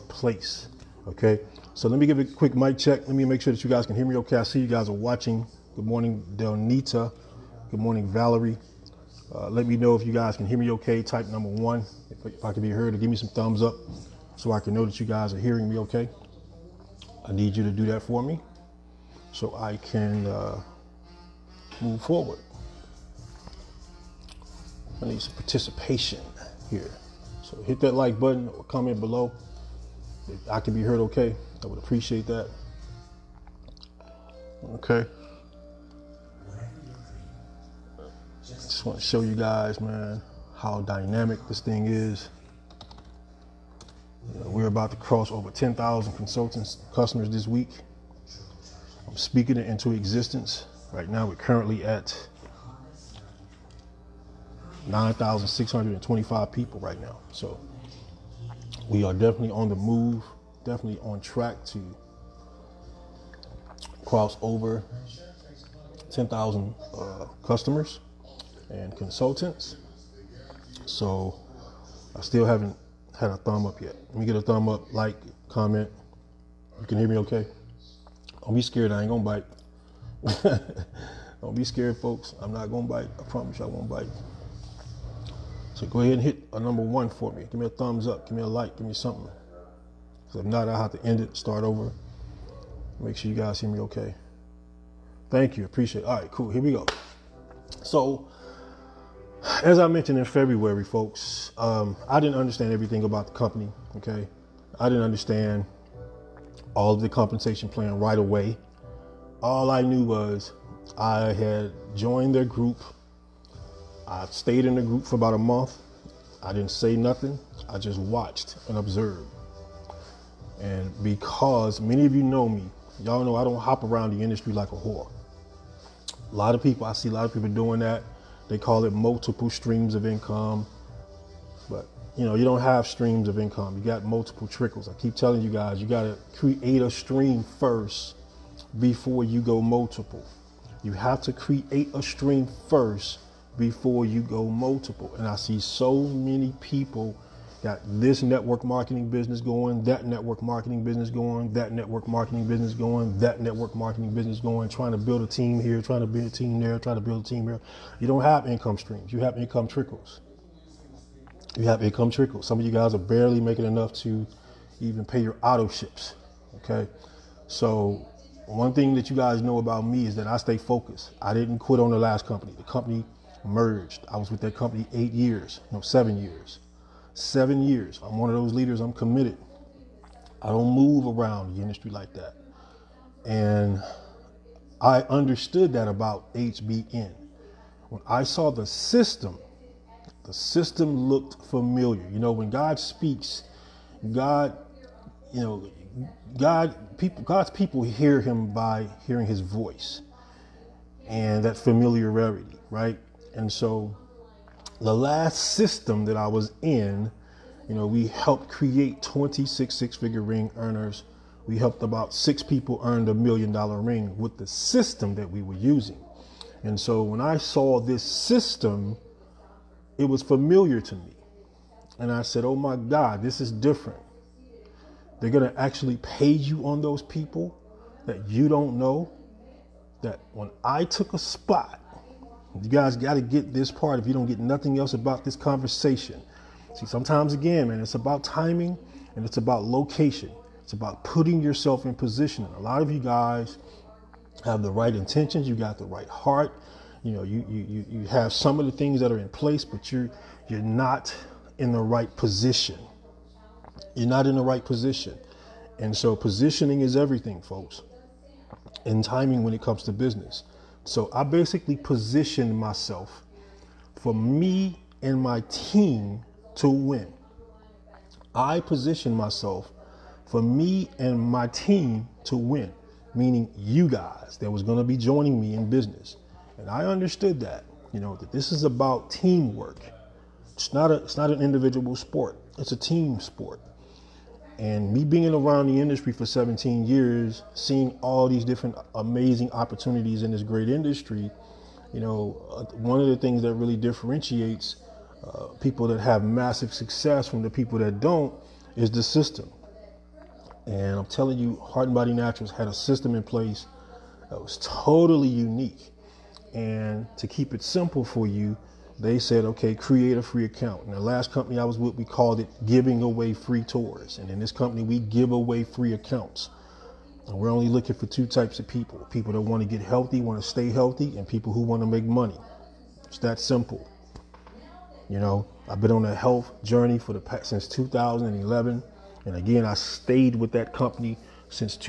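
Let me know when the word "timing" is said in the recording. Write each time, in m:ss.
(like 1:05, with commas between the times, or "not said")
3:58, 4:19.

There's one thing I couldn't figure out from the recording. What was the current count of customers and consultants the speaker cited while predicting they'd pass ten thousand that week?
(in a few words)
9,625.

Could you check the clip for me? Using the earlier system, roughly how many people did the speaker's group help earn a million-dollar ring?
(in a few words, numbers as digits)
6.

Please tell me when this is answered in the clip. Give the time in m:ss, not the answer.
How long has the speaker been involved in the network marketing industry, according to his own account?
4:46.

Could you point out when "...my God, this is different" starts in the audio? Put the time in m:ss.
3:42.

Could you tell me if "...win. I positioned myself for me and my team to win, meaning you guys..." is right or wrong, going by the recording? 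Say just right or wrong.
right.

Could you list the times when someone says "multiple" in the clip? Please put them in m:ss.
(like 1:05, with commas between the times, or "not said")
2:08, 2:14, 2:19, 2:24.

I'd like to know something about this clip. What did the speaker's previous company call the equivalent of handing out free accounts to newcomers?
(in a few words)
free tours.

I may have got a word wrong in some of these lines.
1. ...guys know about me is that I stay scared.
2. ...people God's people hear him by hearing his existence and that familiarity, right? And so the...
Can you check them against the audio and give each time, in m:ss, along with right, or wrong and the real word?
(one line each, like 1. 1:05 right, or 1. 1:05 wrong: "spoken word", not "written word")
1. 2:49 wrong: "focused", not "scared"
2. 3:16 wrong: "voice", not "existence".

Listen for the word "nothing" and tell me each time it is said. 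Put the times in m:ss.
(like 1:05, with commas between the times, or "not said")
1:56, 3:54.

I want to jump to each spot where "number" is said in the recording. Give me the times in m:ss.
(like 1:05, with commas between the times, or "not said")
0:11, 1:26.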